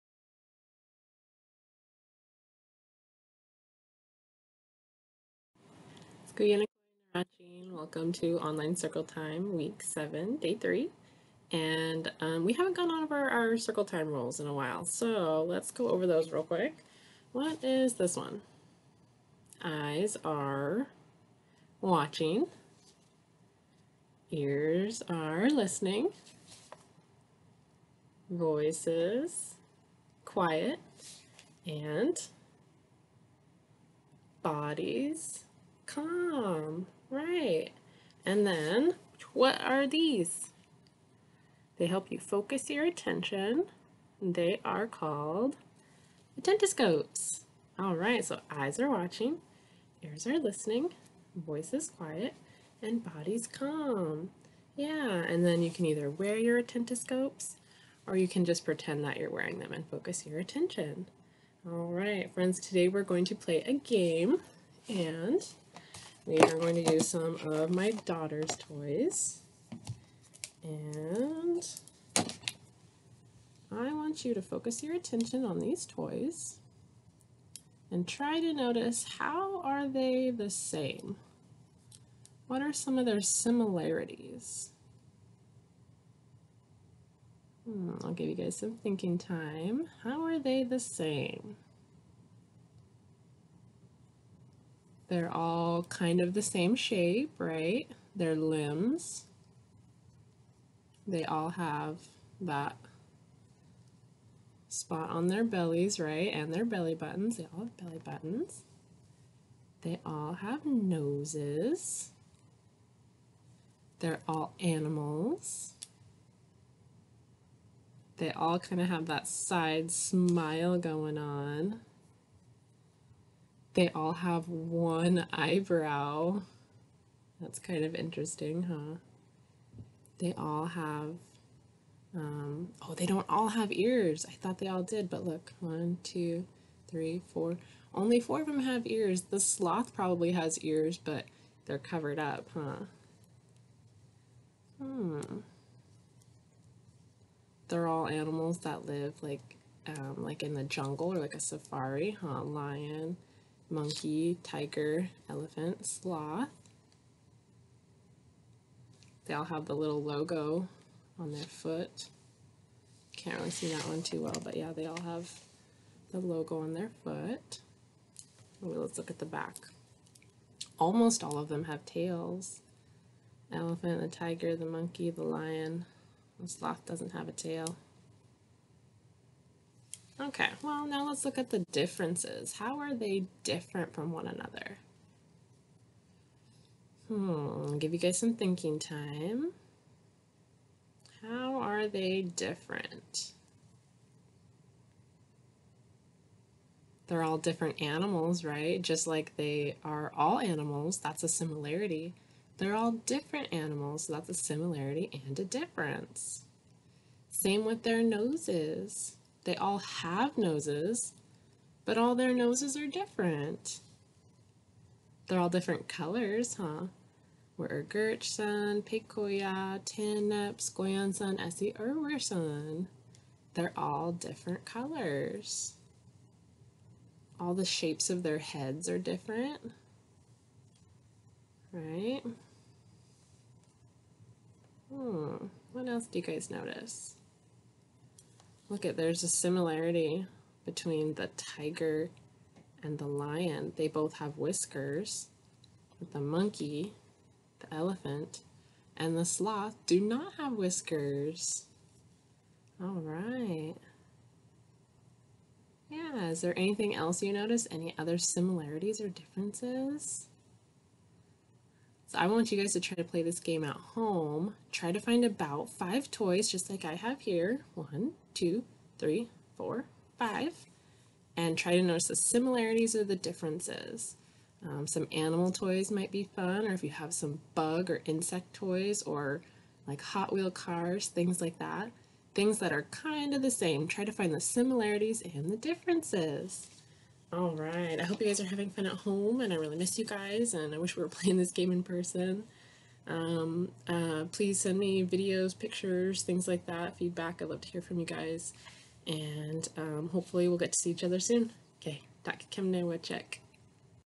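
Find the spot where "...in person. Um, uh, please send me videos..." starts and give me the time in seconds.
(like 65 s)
291 s.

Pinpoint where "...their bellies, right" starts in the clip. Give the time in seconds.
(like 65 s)
105 s.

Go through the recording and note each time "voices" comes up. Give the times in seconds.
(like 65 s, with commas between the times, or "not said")
28 s, 51 s.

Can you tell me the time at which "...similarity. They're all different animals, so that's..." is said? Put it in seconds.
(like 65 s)
201 s.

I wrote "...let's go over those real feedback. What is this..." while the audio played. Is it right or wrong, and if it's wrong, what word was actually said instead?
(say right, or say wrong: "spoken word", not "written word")
wrong: "quick", not "feedback".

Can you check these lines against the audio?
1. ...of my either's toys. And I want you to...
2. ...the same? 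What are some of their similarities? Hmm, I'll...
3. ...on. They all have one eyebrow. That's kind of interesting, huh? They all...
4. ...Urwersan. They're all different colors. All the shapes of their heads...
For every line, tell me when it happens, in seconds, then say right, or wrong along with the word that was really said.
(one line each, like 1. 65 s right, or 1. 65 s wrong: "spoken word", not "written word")
1. 67 s wrong: "daughter", not "either"
2. 80 s right
3. 121 s right
4. 221 s right.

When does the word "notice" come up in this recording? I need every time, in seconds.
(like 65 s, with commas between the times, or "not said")
78 s, 236 s, 257 s, 271 s.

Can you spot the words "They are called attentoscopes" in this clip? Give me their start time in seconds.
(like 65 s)
44 s.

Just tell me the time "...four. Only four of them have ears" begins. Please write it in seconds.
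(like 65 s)
137 s.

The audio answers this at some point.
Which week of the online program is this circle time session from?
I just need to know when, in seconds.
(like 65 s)
9 s.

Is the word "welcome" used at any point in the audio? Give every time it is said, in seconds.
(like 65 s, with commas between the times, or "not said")
7 s.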